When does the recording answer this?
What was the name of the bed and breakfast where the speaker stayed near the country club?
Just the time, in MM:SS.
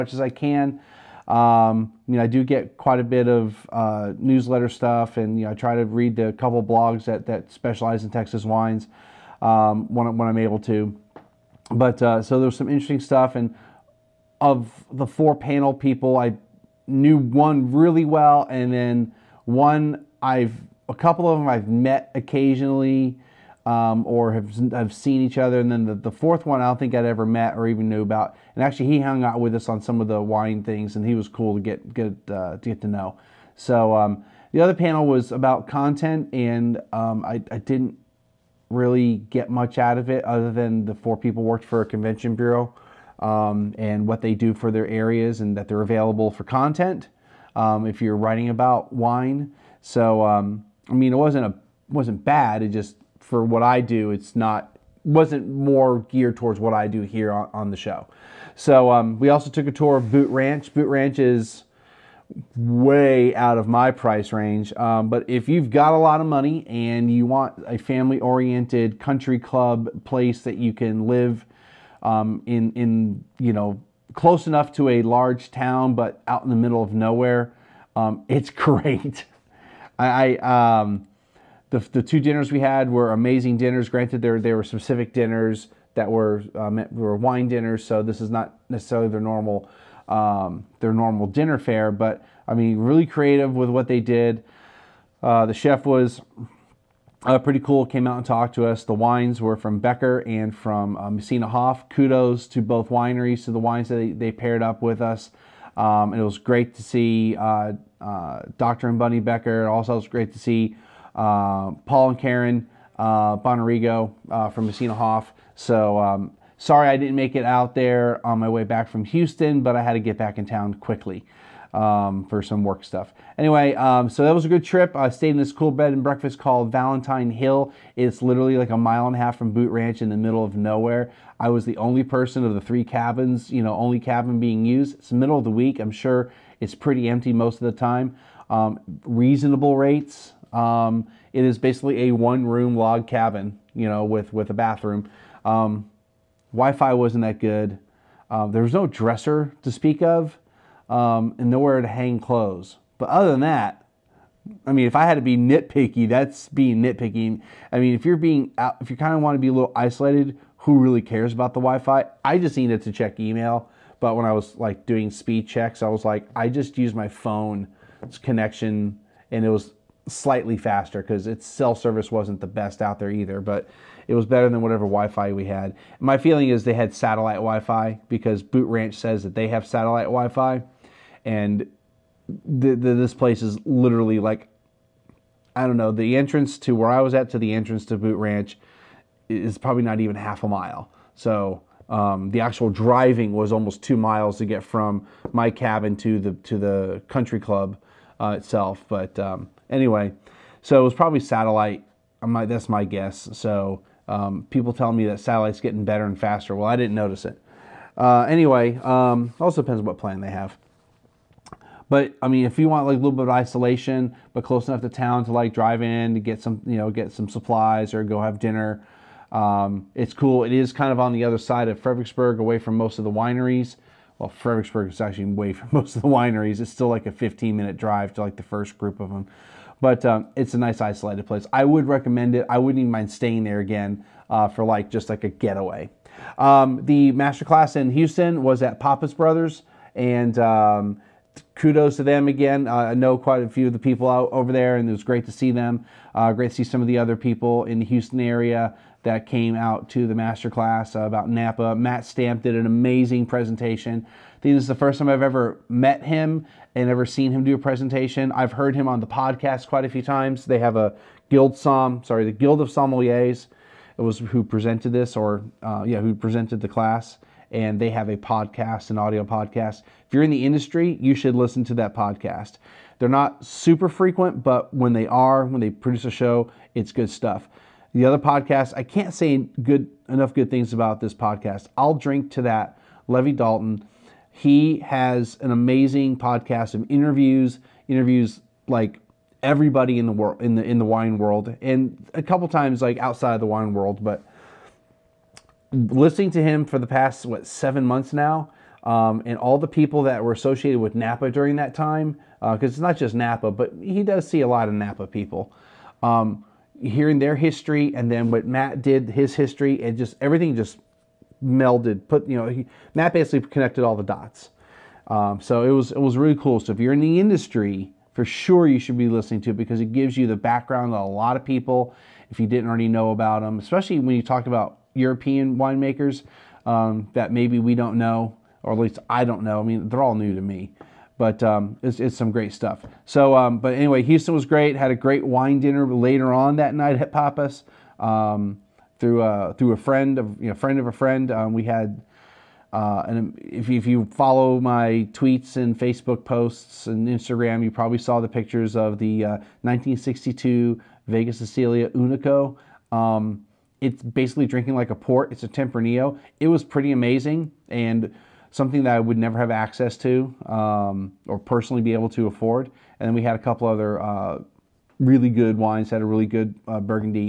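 02:06.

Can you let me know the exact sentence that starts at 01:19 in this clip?
I, I um, the, the two dinners we had were amazing dinners.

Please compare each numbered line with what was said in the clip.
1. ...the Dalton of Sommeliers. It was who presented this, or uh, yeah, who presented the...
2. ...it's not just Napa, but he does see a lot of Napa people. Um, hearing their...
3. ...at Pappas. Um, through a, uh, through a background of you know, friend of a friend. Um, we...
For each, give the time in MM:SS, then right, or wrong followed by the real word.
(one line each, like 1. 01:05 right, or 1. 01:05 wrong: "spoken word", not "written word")
1. 04:22 wrong: "Guild", not "Dalton"
2. 05:02 right
3. 05:37 wrong: "friend", not "background".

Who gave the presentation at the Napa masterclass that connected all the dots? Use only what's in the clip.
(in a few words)
Matt Stamp.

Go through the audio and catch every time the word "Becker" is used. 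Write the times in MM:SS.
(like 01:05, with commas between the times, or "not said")
01:39, 01:49.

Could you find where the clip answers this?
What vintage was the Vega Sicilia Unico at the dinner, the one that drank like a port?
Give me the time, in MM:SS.
05:49.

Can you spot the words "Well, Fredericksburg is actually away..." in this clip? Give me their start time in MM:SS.
03:44.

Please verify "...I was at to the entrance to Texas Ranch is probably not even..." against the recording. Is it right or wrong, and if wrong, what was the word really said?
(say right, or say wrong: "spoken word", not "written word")
wrong: "Boot", not "Texas".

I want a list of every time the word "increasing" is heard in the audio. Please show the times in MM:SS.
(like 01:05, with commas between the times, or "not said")
not said.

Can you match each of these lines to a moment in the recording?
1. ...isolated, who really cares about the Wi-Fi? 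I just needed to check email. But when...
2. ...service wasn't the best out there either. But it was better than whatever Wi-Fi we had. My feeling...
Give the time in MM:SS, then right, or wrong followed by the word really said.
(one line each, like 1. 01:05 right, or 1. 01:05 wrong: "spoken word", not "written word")
1. 02:39 right
2. 02:51 right.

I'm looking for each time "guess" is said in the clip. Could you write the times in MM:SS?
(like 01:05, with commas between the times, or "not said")
03:22.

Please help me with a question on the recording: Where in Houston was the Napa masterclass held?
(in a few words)
Pappas Brothers.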